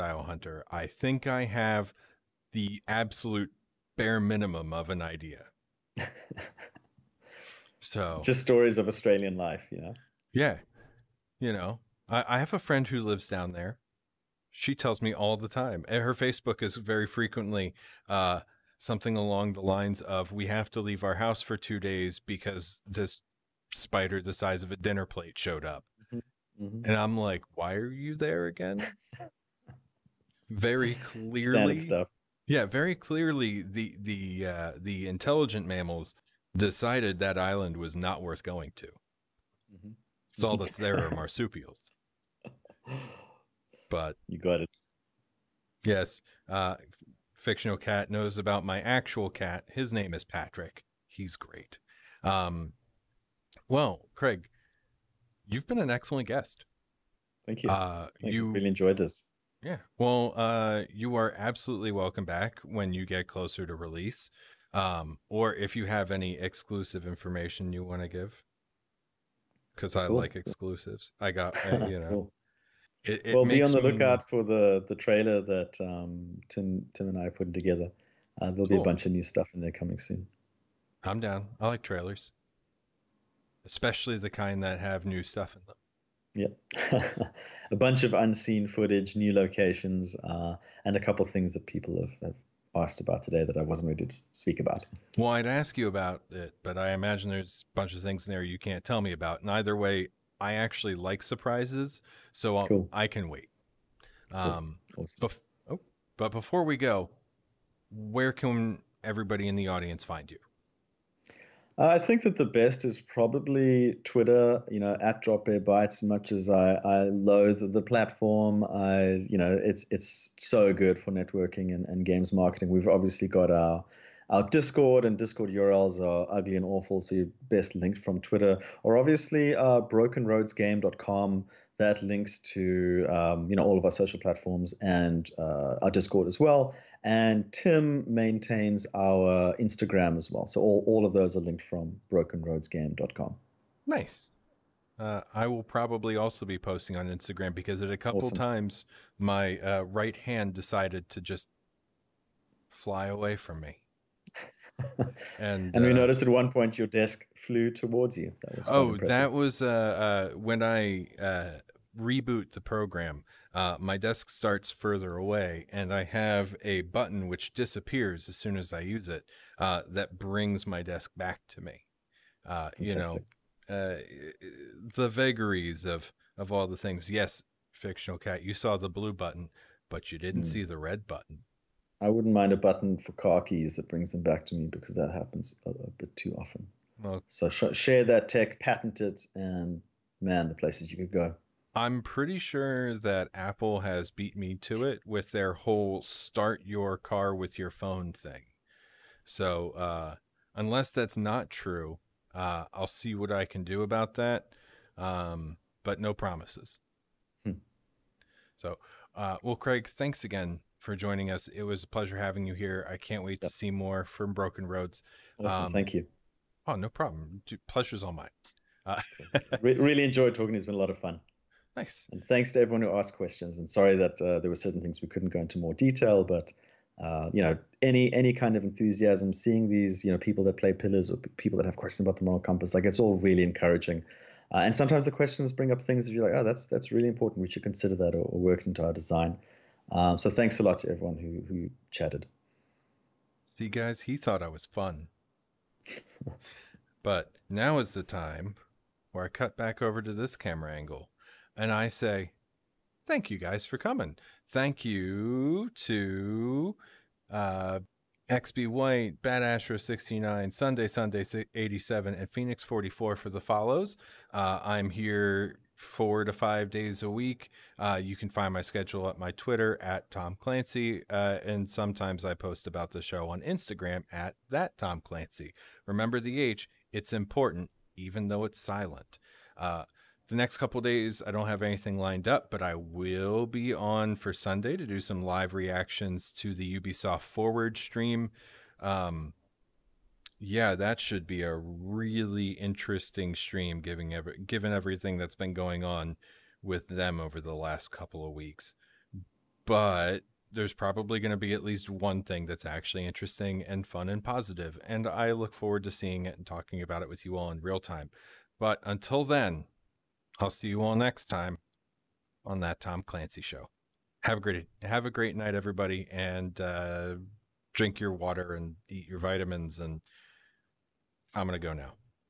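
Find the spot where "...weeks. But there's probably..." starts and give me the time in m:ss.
4:58.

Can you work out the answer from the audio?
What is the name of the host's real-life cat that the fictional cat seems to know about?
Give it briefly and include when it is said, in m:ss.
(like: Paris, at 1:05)
Patrick, at 0:50.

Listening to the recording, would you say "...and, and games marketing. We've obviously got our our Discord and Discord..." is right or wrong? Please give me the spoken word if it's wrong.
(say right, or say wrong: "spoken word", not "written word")
right.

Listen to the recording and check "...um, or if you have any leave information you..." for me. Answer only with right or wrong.
wrong.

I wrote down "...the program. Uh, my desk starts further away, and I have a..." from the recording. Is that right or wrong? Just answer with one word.
right.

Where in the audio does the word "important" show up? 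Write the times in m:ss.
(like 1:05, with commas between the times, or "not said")
3:57, 4:37.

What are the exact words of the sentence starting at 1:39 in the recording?
And either way, I actually like surprises, so cool.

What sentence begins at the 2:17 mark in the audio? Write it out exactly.
And Tim maintains our Instagram as well.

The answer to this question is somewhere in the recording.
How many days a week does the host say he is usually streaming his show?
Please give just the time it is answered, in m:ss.
4:25.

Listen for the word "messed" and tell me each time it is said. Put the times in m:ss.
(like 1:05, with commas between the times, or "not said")
not said.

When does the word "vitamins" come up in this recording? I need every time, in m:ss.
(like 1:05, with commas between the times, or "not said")
5:19.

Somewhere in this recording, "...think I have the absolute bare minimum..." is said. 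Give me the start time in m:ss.
0:00.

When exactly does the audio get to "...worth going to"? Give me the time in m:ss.
0:38.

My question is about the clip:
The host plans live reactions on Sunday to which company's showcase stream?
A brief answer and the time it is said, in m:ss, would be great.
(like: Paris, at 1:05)
Ubisoft Forward, at 4:46.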